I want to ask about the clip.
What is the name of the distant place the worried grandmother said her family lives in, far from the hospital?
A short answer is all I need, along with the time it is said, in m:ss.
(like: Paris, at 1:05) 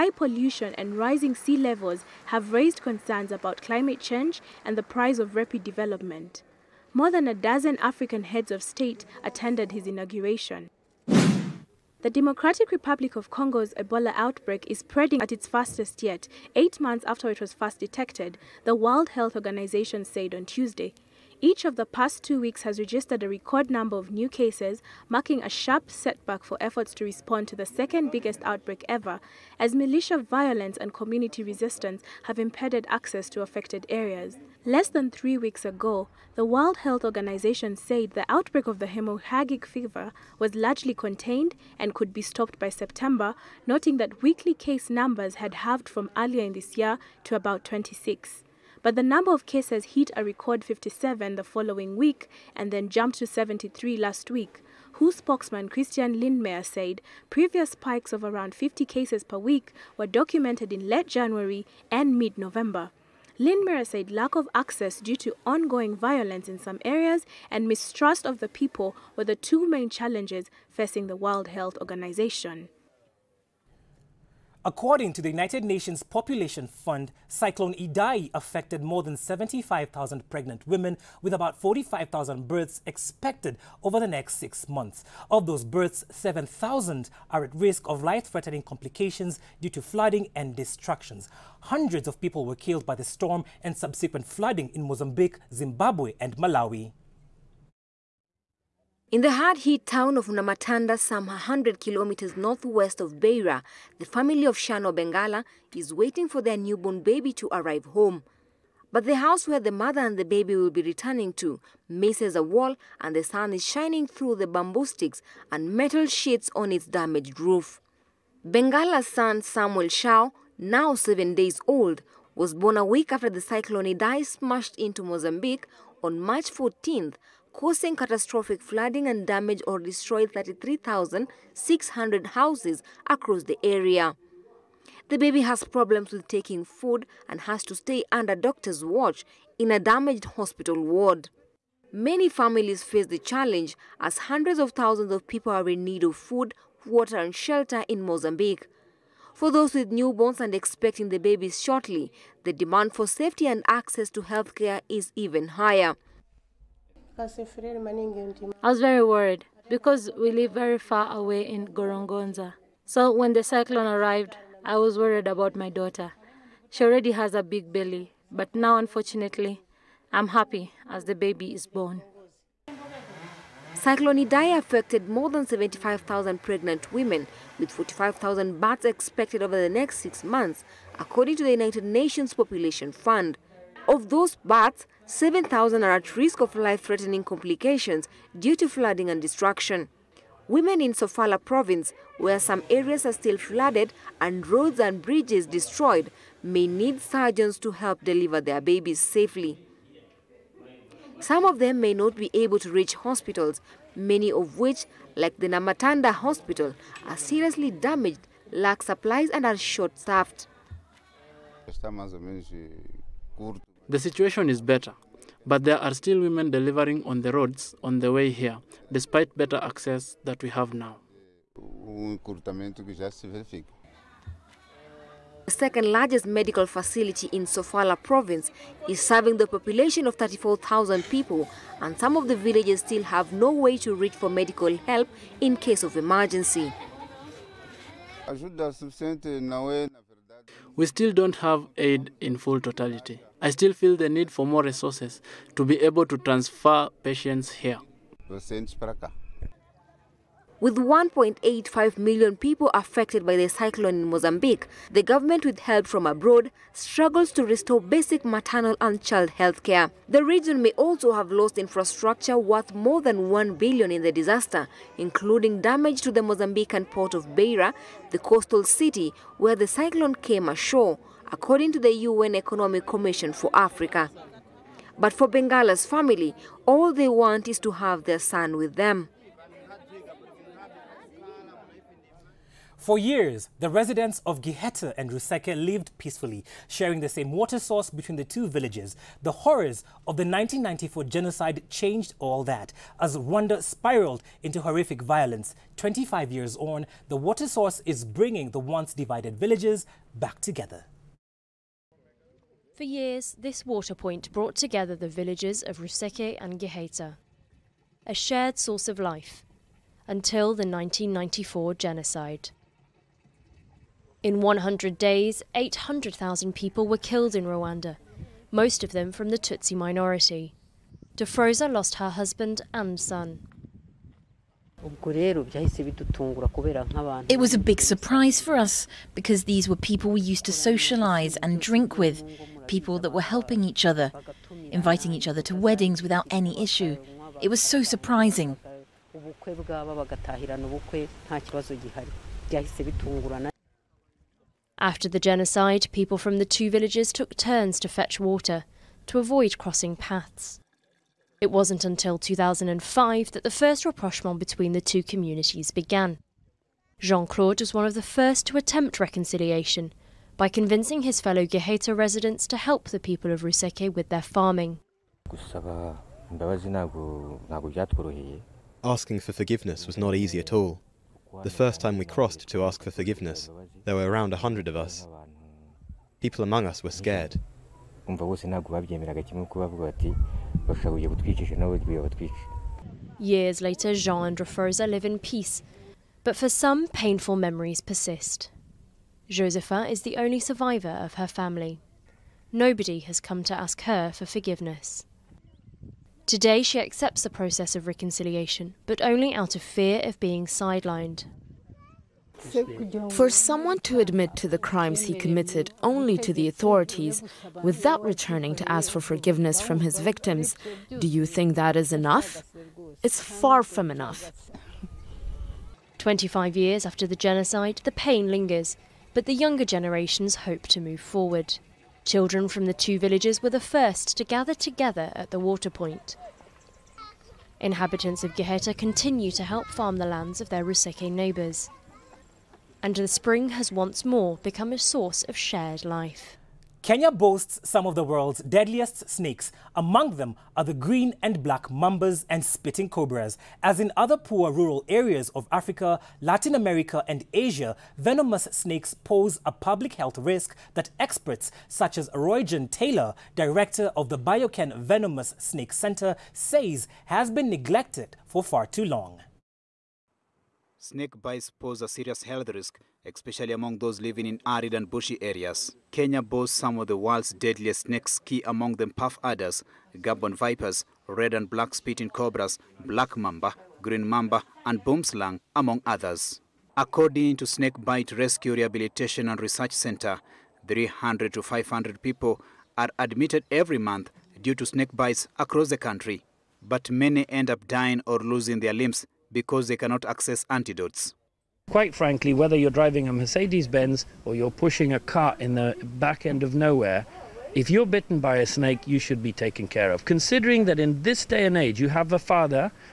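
Gorongosa, at 2:41.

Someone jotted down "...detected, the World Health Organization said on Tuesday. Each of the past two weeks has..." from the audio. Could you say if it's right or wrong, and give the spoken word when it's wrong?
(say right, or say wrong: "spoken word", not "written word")
right.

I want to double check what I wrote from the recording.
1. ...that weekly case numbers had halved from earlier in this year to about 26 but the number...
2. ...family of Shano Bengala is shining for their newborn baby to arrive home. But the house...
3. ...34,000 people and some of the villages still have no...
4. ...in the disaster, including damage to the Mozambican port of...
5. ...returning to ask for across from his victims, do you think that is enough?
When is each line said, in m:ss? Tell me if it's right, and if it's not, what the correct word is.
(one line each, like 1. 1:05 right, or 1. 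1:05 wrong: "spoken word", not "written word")
1. 0:43 right
2. 1:44 wrong: "waiting", not "shining"
3. 3:50 right
4. 4:23 right
5. 6:48 wrong: "forgiveness", not "across".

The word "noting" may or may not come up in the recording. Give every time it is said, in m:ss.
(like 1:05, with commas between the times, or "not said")
0:43.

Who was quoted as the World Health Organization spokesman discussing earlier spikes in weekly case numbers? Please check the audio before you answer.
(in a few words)
Christian Lindmeier.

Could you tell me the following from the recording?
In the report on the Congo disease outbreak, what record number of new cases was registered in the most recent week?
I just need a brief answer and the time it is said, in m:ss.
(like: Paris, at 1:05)
73, at 0:53.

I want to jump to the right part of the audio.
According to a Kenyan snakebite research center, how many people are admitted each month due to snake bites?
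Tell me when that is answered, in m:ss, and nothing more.
8:00.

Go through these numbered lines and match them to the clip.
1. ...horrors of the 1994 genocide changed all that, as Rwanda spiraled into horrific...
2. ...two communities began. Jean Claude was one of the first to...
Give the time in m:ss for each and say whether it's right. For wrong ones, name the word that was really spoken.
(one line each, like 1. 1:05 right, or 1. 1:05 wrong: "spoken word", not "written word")
1. 4:49 right
2. 5:54 right.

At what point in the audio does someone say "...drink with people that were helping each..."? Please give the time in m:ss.
5:31.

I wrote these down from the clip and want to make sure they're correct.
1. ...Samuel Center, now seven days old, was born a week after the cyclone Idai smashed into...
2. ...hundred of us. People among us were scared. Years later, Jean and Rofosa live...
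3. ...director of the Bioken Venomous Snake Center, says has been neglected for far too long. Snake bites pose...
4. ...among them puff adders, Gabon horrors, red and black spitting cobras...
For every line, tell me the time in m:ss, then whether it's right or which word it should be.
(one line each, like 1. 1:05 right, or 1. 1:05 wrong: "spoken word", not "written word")
1. 1:59 wrong: "Shao", not "Center"
2. 6:14 right
3. 7:33 right
4. 7:48 wrong: "vipers", not "horrors".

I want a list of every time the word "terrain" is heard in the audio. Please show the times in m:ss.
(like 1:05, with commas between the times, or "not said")
not said.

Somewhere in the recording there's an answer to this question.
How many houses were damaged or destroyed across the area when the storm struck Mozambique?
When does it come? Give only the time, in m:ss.
2:10.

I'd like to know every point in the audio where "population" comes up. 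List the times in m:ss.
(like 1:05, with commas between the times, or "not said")
1:16, 3:02, 3:49.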